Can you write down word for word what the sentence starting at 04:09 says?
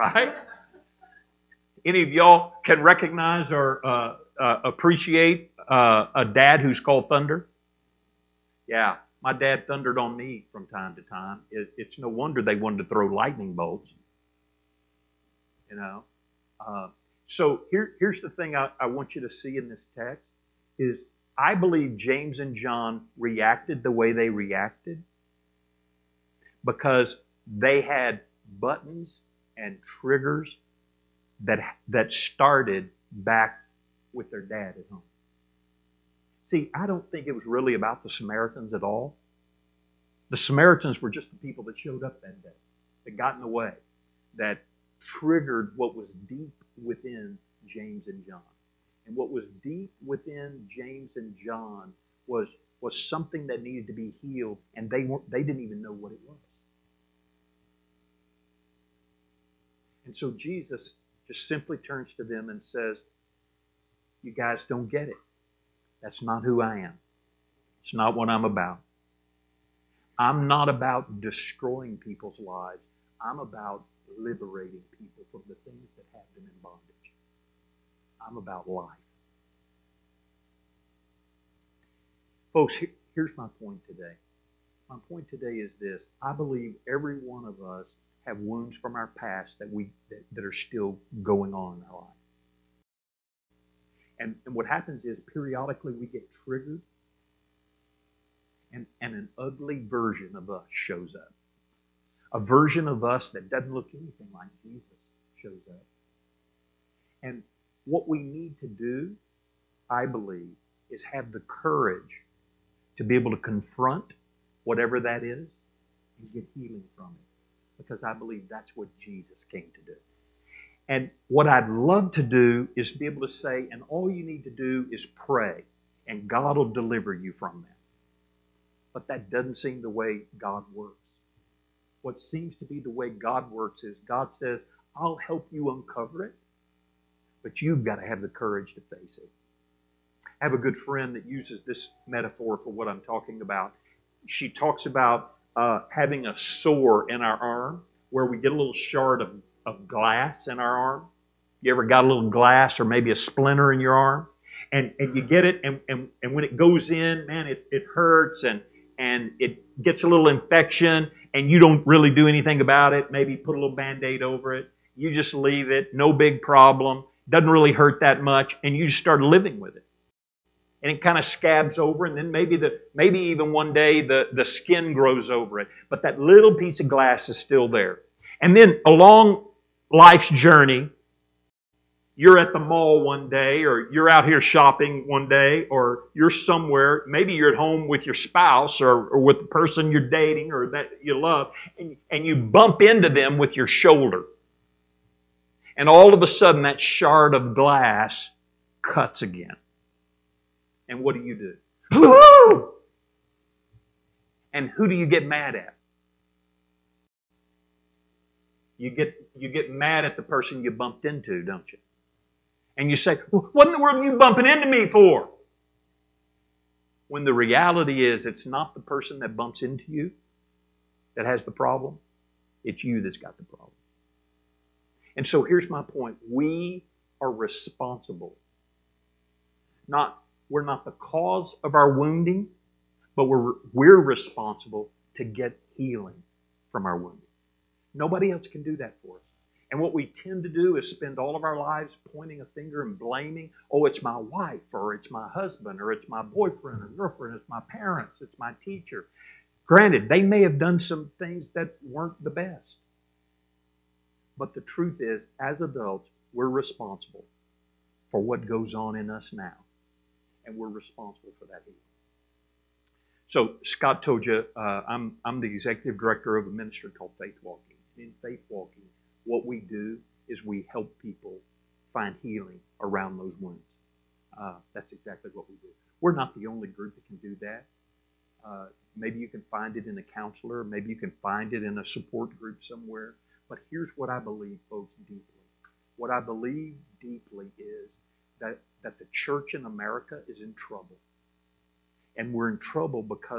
Granted, they may have done some things that weren't the best.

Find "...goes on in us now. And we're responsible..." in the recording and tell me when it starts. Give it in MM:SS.
04:18.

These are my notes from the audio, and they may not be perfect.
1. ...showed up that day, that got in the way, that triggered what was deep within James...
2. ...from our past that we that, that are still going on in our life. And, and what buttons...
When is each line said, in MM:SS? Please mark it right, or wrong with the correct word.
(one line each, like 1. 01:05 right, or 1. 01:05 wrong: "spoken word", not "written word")
1. 00:41 right
2. 01:28 wrong: "happens", not "buttons".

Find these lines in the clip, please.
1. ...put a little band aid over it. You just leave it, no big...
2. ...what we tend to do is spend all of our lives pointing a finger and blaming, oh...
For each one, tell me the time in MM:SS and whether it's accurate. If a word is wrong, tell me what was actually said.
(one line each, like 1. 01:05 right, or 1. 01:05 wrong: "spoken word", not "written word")
1. 02:43 right
2. 03:59 right.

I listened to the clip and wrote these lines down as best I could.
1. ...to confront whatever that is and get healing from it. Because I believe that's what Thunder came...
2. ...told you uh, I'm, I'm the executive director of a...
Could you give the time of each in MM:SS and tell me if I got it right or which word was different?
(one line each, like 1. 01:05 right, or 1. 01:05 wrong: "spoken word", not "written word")
1. 01:53 wrong: "Jesus", not "Thunder"
2. 04:24 right.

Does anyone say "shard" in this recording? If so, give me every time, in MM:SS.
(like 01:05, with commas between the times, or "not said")
02:28, 03:16.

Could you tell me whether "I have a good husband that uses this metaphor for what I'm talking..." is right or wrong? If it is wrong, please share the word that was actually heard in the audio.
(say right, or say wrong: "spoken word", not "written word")
wrong: "friend", not "husband".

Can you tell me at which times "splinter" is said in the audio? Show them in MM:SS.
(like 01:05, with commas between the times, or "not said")
02:33.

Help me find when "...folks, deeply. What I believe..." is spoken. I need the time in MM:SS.
04:44.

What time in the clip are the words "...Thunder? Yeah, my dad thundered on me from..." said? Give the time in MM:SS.
00:07.